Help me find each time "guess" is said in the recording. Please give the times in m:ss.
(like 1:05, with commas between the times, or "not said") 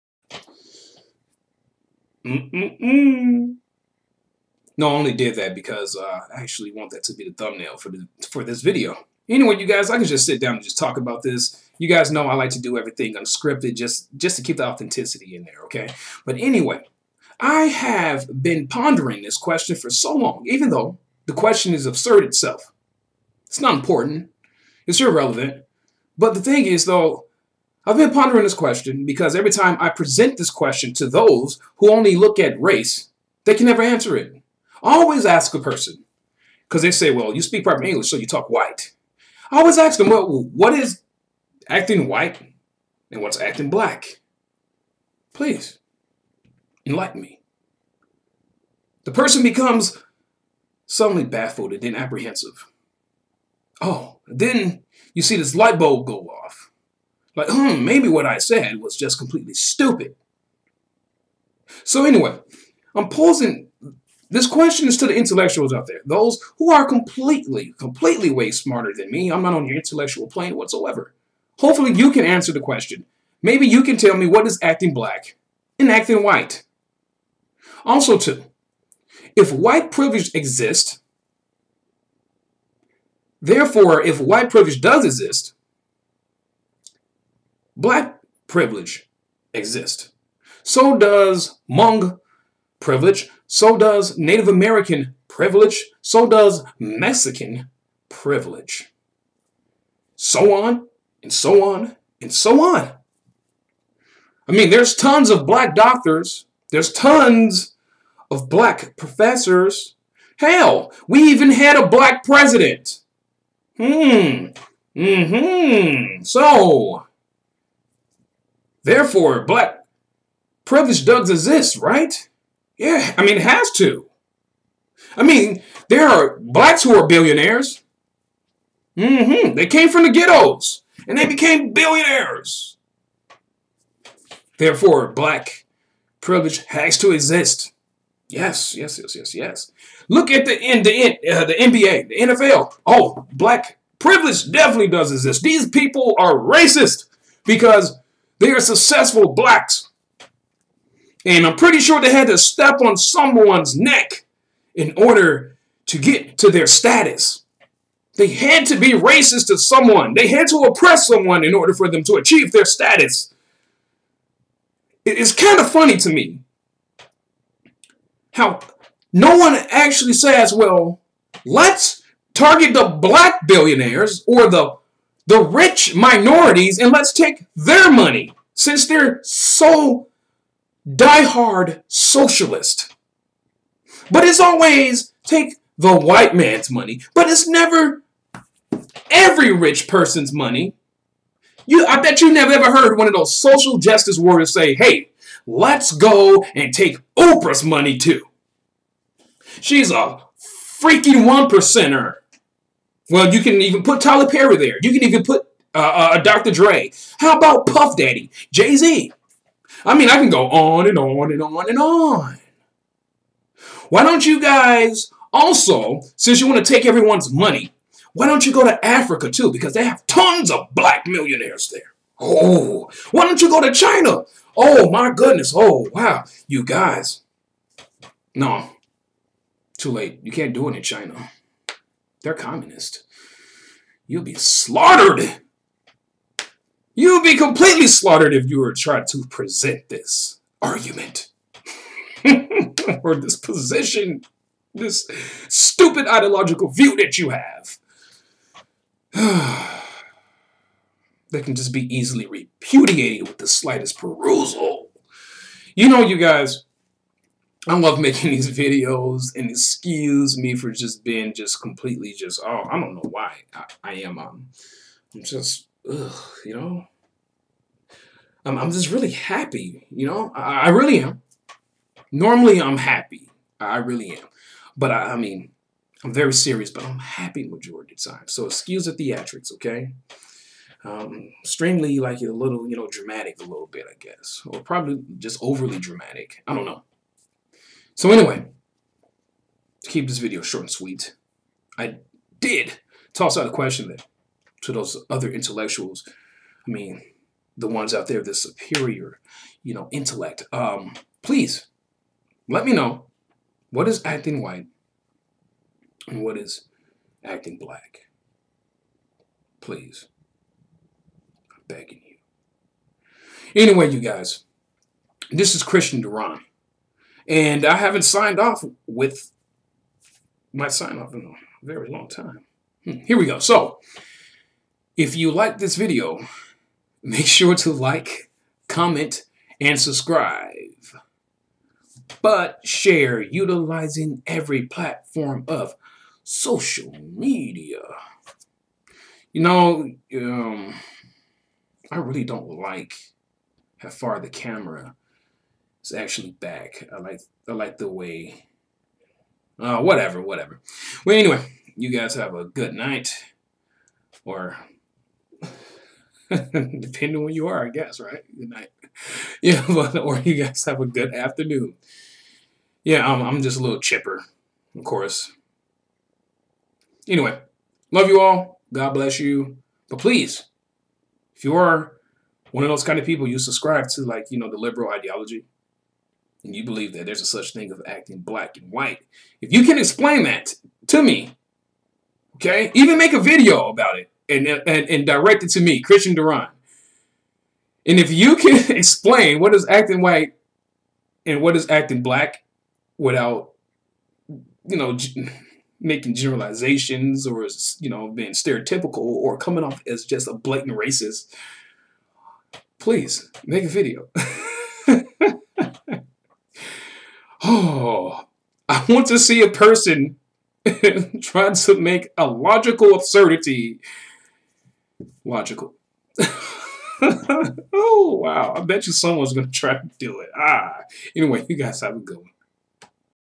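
4:43, 5:57.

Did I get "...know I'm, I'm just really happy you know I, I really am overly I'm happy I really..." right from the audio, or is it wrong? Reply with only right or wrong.
wrong.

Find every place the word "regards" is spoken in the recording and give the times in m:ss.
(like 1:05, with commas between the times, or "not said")
not said.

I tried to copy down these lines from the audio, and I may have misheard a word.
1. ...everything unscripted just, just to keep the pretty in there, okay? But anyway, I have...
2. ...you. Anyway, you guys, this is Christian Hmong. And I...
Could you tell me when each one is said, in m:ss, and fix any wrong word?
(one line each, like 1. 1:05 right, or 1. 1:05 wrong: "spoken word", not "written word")
1. 0:12 wrong: "authenticity", not "pretty"
2. 5:12 wrong: "Duran", not "Hmong".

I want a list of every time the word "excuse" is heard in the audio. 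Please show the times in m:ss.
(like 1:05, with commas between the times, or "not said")
4:19, 4:38.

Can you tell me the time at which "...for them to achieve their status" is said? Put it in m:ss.
2:41.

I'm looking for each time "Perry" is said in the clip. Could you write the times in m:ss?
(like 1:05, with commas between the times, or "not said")
3:24.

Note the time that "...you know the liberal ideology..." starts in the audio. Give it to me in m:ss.
6:14.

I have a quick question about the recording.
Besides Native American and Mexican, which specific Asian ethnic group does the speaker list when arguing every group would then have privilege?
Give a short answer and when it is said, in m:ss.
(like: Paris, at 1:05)
Hmong, at 1:31.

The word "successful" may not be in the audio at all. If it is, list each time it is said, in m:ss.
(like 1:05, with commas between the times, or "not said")
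2:28.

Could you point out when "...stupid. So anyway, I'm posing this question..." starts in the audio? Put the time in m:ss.
0:59.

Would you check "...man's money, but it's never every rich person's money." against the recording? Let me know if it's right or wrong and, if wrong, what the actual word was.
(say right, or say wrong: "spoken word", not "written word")
right.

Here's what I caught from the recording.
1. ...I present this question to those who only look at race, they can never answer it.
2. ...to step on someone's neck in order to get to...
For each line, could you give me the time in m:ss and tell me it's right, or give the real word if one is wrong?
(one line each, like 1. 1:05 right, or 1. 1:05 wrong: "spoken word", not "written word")
1. 0:29 right
2. 2:32 right.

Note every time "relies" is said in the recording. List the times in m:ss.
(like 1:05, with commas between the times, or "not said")
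not said.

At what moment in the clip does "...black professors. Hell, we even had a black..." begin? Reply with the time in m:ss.
1:48.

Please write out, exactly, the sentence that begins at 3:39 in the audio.
Because they have tons of black millionaires there.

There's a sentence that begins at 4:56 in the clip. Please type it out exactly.
I mean, the ones out there, the superior, you know, intellect.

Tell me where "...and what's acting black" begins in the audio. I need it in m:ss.
0:43.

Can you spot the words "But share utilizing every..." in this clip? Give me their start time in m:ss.
5:32.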